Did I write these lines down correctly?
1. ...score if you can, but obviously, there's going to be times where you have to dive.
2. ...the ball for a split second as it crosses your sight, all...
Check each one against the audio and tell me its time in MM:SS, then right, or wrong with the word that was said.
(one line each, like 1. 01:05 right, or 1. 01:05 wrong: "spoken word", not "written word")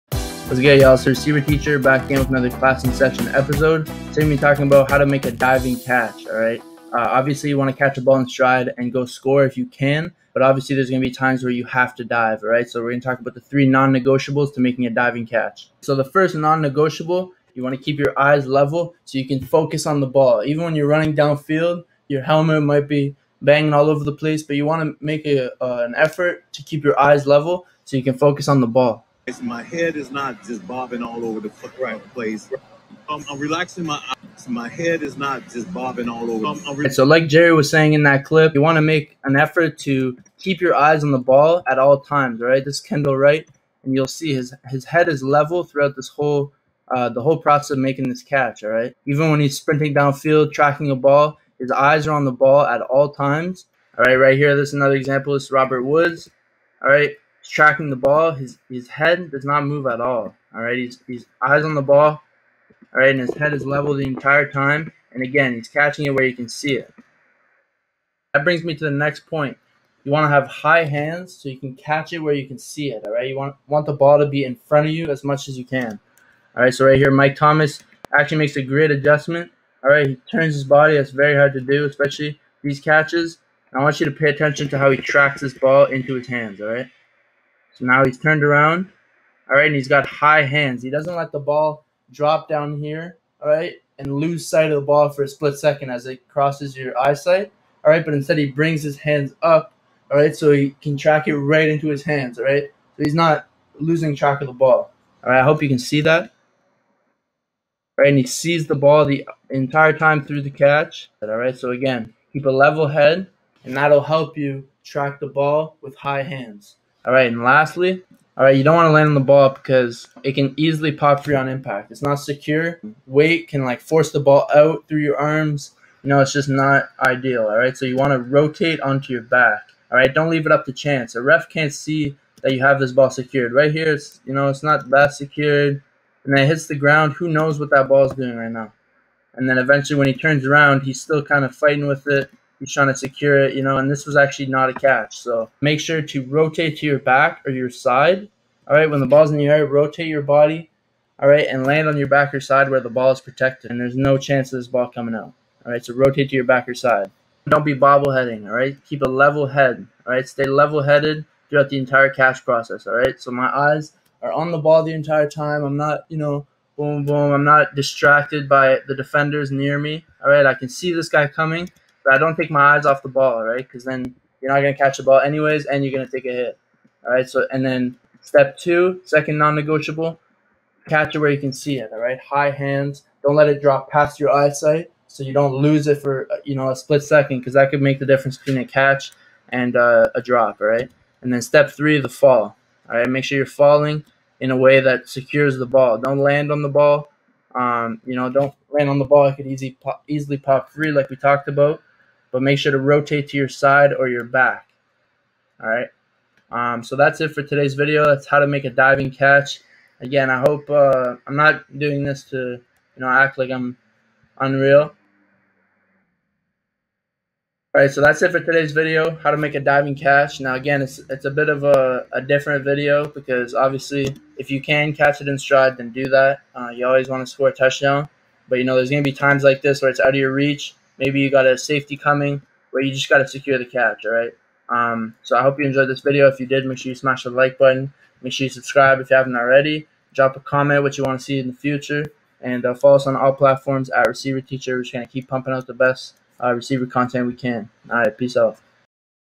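1. 00:09 right
2. 01:34 wrong: "eyesight", not "sight".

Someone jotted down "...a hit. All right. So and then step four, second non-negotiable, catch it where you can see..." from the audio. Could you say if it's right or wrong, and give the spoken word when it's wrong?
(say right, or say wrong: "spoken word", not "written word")
wrong: "two", not "four".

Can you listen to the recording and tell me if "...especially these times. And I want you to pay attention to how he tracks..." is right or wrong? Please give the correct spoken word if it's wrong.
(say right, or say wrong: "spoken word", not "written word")
wrong: "catches", not "times".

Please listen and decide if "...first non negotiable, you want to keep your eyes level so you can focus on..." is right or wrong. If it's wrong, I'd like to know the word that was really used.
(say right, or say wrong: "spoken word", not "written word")
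right.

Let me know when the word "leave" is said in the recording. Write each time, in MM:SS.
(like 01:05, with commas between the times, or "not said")
02:10.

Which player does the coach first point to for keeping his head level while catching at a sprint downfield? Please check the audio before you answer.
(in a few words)
Kendall Wright.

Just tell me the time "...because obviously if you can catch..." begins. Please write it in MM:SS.
03:43.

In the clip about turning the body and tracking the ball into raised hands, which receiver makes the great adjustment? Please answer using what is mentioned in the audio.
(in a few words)
Mike Thomas.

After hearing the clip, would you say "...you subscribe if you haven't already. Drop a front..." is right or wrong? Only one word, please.
wrong.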